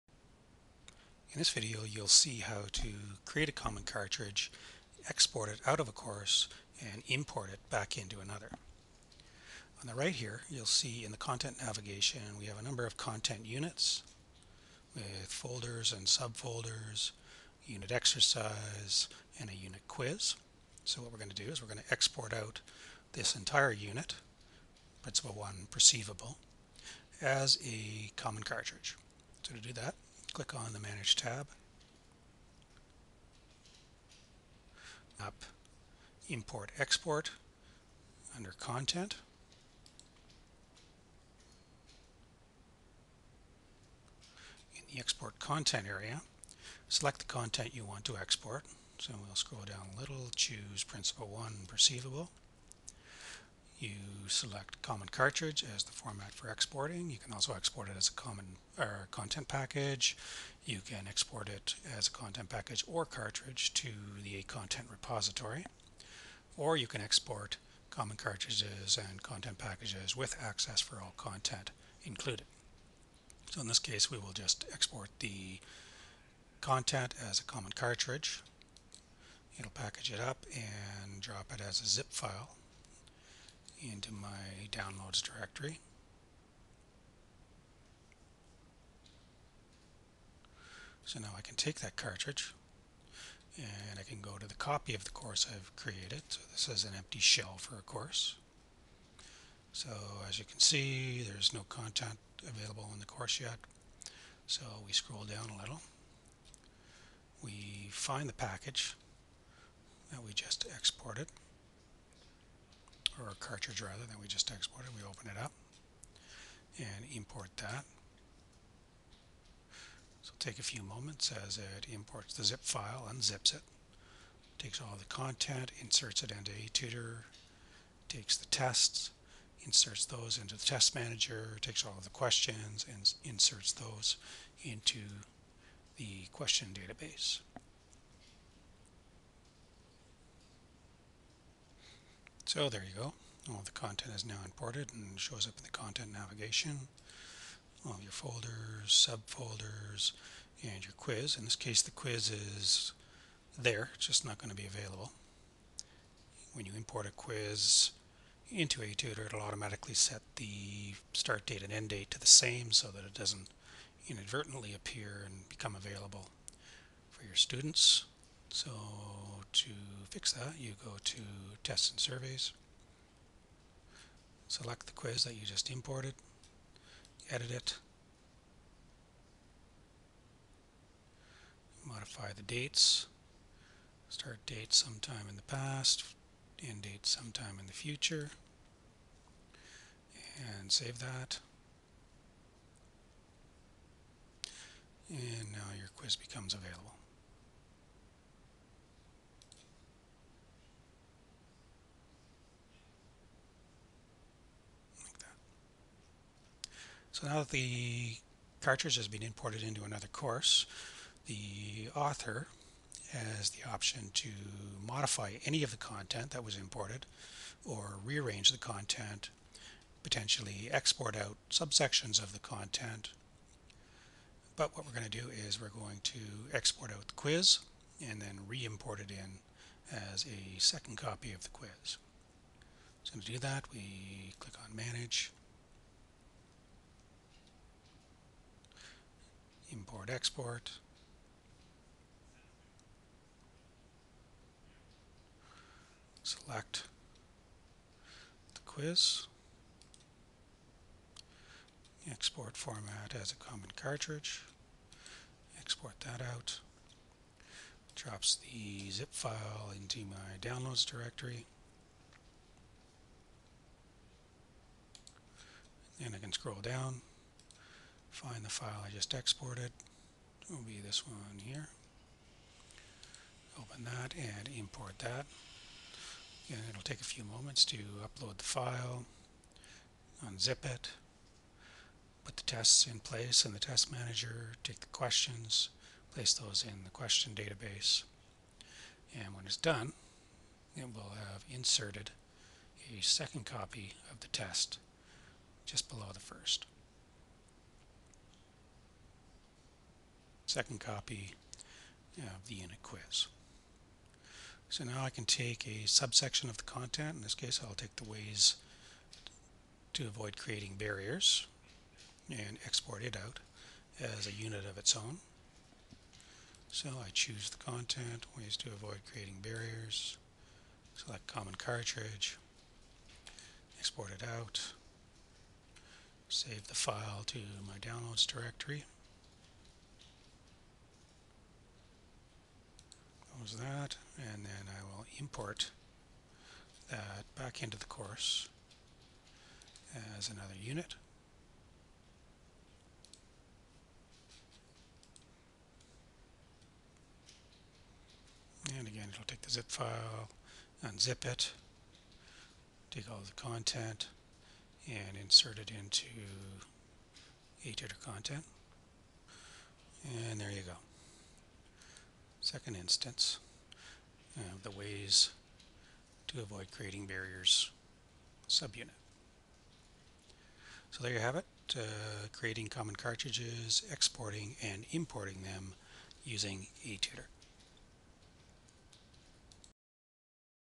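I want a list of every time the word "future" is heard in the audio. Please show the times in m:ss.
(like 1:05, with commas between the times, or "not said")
3:07.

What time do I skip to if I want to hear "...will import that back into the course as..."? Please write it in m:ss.
5:34.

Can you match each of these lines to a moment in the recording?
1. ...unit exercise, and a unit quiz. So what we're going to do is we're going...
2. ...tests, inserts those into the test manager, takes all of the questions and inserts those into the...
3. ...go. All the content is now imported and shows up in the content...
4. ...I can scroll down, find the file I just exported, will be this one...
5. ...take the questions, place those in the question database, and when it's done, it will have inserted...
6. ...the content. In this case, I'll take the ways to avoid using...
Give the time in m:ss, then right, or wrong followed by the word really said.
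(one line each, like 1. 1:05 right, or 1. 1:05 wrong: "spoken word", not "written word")
1. 0:17 right
2. 2:08 right
3. 2:23 right
4. 4:26 right
5. 4:44 right
6. 5:06 wrong: "creating", not "using".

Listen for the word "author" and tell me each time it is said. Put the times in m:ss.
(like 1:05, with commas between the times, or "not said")
3:31.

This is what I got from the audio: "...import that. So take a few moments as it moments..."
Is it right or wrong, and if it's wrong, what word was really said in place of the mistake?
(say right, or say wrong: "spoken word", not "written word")
wrong: "imports", not "moments".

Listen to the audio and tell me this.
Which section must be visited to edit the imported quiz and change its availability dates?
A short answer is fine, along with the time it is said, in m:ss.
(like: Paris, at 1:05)
Tests and Surveys, at 2:51.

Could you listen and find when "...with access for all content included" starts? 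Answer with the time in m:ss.
1:10.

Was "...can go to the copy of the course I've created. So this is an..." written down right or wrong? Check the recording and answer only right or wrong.
right.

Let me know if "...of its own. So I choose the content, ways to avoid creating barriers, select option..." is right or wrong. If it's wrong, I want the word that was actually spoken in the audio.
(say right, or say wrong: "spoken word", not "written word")
wrong: "common", not "option".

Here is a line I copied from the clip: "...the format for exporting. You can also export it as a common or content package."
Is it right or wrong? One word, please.
right.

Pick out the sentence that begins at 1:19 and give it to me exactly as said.
It'll package it up and drop it as a zip file into my downloads directory.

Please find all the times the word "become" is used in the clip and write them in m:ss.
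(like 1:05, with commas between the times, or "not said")
2:45, 3:16.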